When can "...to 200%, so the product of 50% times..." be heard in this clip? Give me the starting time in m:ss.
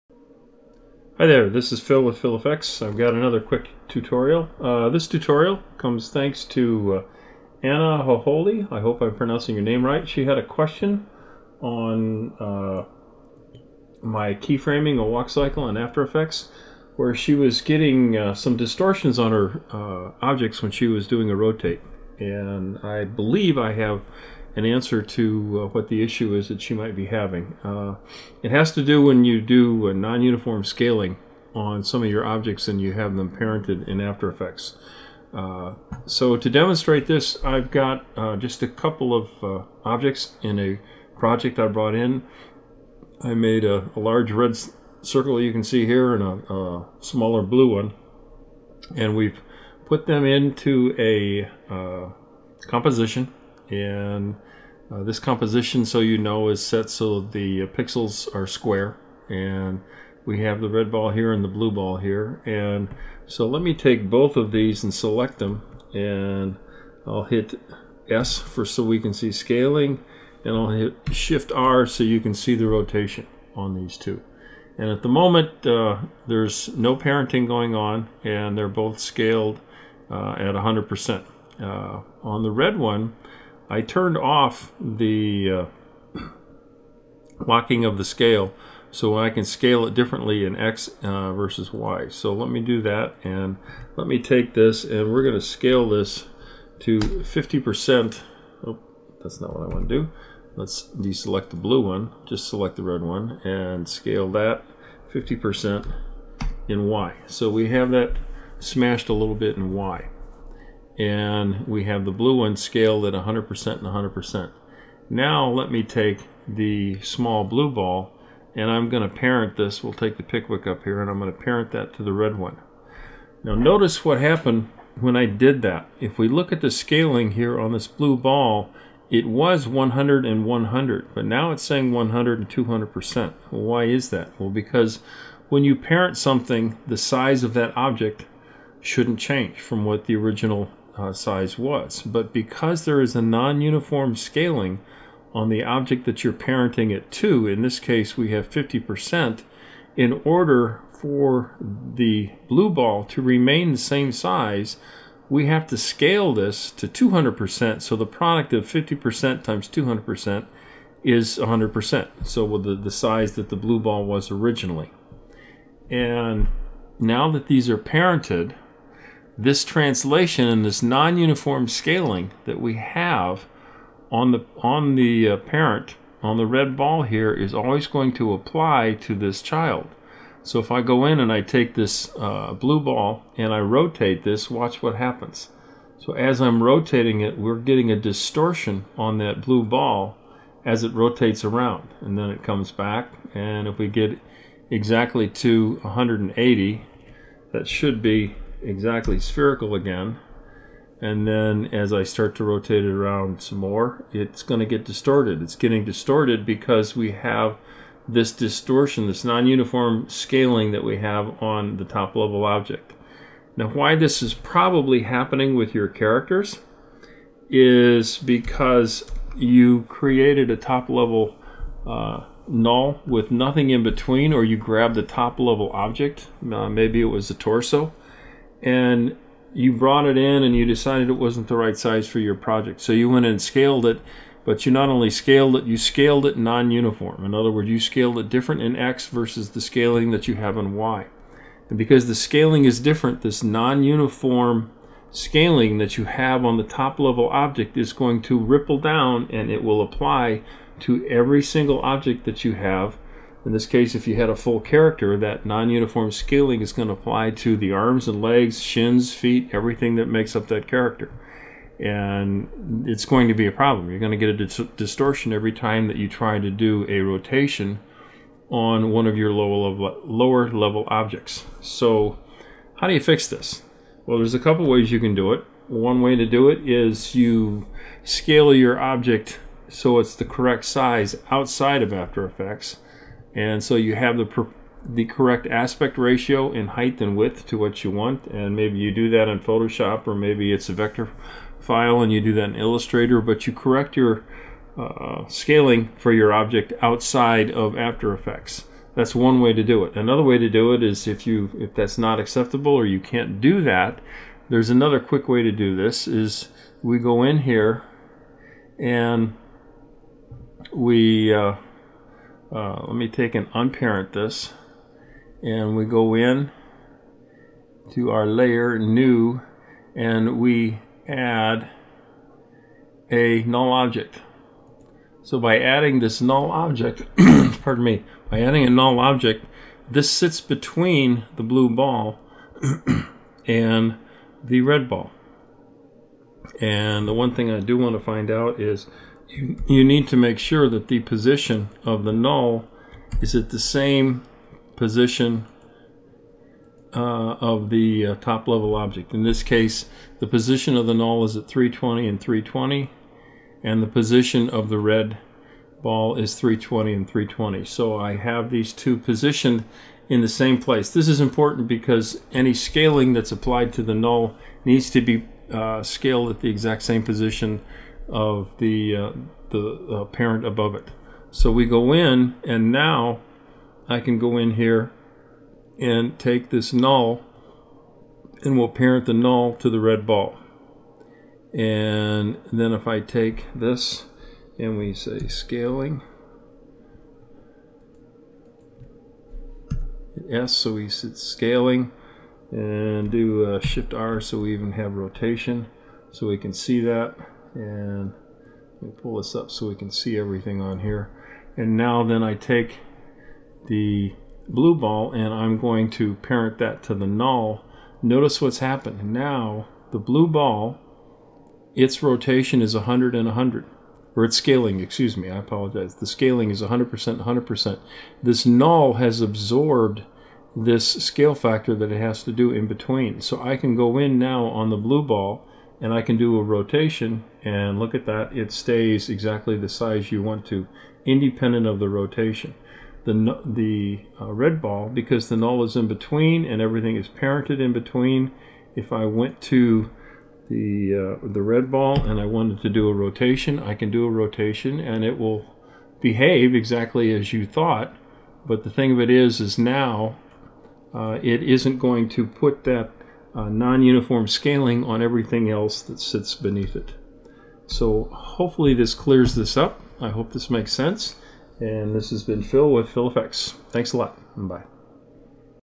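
2:36.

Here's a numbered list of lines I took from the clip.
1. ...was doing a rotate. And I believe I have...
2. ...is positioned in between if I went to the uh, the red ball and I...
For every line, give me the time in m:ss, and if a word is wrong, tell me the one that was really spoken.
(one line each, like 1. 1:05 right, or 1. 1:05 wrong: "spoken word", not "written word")
1. 0:20 right
2. 7:16 wrong: "parented", not "positioned".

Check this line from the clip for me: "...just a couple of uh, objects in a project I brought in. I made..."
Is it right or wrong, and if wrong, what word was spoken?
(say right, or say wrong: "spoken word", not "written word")
right.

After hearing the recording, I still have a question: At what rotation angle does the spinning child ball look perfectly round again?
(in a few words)
180.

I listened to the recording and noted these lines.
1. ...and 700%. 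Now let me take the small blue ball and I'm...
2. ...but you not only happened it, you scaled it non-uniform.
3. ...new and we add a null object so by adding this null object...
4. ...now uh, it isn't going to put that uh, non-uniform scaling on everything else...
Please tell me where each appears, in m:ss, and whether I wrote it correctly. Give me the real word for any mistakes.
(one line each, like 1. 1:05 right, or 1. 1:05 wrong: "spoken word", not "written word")
1. 1:53 wrong: "100", not "700"
2. 3:54 wrong: "scaled", not "happened"
3. 5:18 right
4. 7:29 right.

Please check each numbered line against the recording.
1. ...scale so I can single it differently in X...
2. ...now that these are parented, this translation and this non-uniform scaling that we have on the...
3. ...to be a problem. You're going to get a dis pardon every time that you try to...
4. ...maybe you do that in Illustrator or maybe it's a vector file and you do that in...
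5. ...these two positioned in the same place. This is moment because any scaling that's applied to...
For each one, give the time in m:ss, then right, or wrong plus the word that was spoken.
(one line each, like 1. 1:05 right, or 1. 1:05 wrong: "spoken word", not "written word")
1. 1:28 wrong: "scale", not "single"
2. 2:46 right
3. 4:23 wrong: "distortion", not "pardon"
4. 4:48 wrong: "Photoshop", not "Illustrator"
5. 5:58 wrong: "important", not "moment".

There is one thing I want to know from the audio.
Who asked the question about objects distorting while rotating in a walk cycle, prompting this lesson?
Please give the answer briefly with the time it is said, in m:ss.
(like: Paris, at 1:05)
Anna Hoholi, at 0:07.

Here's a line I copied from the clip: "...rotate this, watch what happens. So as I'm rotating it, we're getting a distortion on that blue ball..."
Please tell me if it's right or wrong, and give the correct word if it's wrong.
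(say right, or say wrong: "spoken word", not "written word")
right.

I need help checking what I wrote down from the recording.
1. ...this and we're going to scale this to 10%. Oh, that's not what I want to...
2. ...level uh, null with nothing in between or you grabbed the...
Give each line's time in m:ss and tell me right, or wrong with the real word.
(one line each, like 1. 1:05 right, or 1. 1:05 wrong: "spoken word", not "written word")
1. 1:34 wrong: "50", not "10"
2. 3:40 right.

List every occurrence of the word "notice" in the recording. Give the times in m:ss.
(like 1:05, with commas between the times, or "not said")
2:03, 6:48.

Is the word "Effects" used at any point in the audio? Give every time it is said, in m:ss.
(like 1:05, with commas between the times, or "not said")
0:16, 0:34, 4:42, 4:58.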